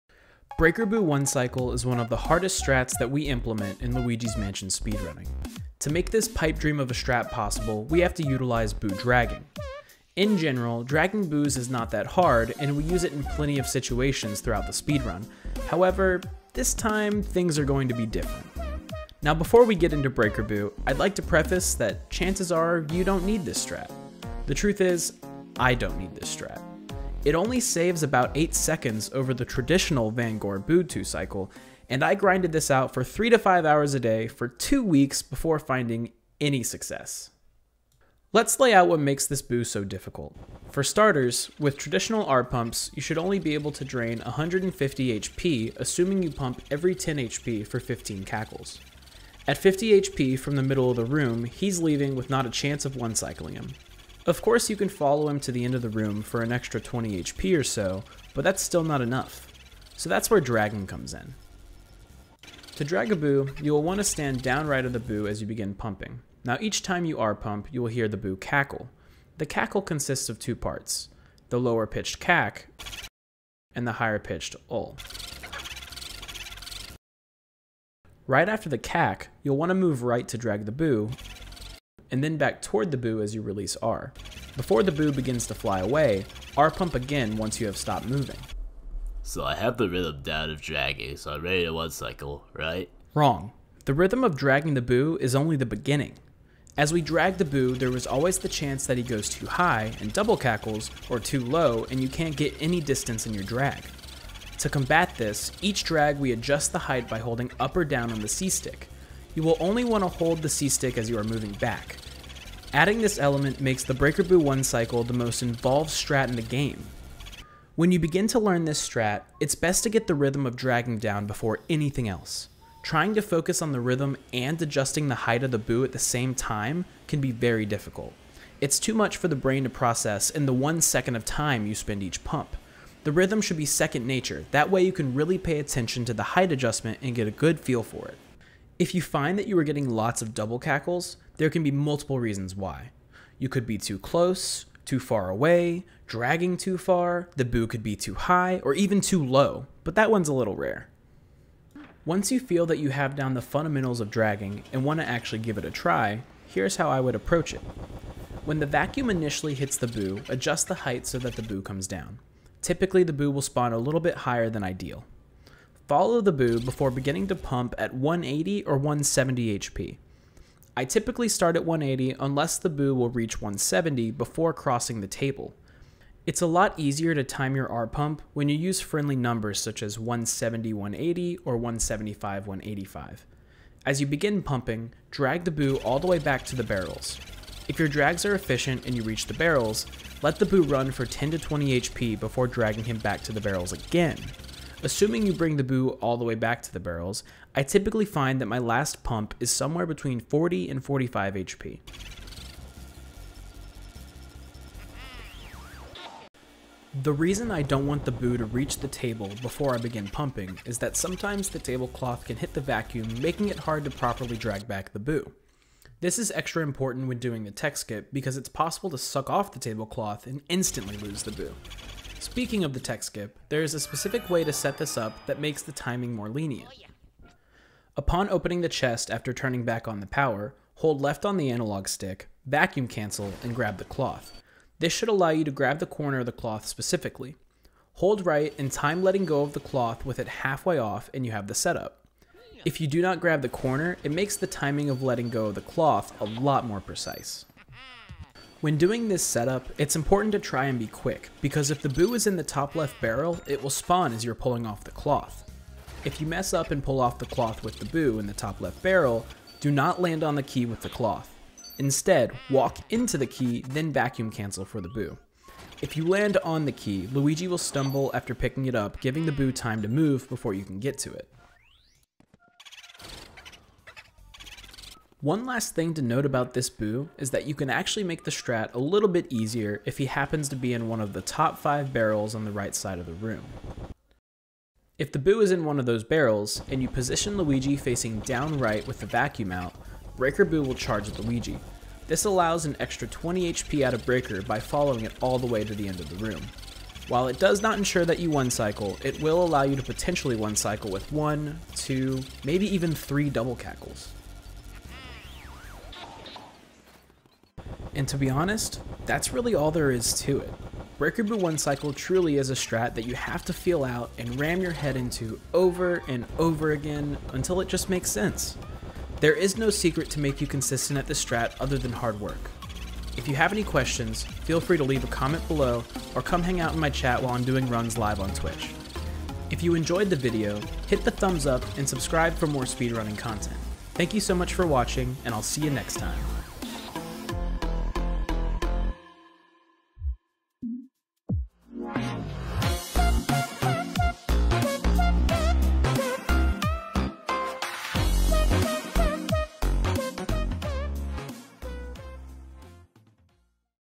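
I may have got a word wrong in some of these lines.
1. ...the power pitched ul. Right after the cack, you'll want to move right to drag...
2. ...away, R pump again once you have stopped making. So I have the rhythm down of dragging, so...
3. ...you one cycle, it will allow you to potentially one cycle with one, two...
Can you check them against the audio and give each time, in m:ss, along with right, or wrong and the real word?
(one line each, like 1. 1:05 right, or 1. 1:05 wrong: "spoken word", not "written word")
1. 1:13 wrong: "higher", not "power"
2. 1:25 wrong: "moving", not "making"
3. 4:58 right.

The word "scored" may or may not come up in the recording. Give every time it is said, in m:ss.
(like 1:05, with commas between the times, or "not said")
not said.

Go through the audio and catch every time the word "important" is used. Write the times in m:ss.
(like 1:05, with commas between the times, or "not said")
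3:36, 4:09.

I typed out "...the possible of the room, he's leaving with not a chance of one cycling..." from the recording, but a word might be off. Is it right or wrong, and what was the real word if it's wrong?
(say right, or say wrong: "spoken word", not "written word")
wrong: "middle", not "possible".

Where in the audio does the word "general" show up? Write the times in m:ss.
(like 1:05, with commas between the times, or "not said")
0:10.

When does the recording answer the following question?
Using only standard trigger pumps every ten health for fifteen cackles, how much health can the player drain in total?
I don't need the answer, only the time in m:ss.
0:44.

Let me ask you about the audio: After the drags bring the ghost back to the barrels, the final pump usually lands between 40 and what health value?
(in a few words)
45.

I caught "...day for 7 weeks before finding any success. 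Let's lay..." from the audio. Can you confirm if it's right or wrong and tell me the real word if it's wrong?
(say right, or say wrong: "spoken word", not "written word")
wrong: "2", not "7".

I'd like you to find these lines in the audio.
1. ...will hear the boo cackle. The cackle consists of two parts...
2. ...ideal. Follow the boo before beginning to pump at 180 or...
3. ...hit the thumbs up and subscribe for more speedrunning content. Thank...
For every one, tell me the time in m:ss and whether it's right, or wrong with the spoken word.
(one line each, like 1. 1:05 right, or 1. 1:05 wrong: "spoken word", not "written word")
1. 1:07 right
2. 2:44 right
3. 5:30 right.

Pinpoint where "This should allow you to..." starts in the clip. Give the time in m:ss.
3:54.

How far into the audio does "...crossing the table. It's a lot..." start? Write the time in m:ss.
2:54.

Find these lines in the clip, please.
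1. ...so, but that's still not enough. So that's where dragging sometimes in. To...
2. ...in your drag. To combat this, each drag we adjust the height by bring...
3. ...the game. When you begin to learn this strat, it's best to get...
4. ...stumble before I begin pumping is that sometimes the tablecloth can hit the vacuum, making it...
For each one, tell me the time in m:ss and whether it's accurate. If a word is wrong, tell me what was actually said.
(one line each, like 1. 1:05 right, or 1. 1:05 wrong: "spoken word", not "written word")
1. 0:57 wrong: "comes", not "sometimes"
2. 1:43 wrong: "holding", not "bring"
3. 1:56 right
4. 3:28 wrong: "table", not "stumble".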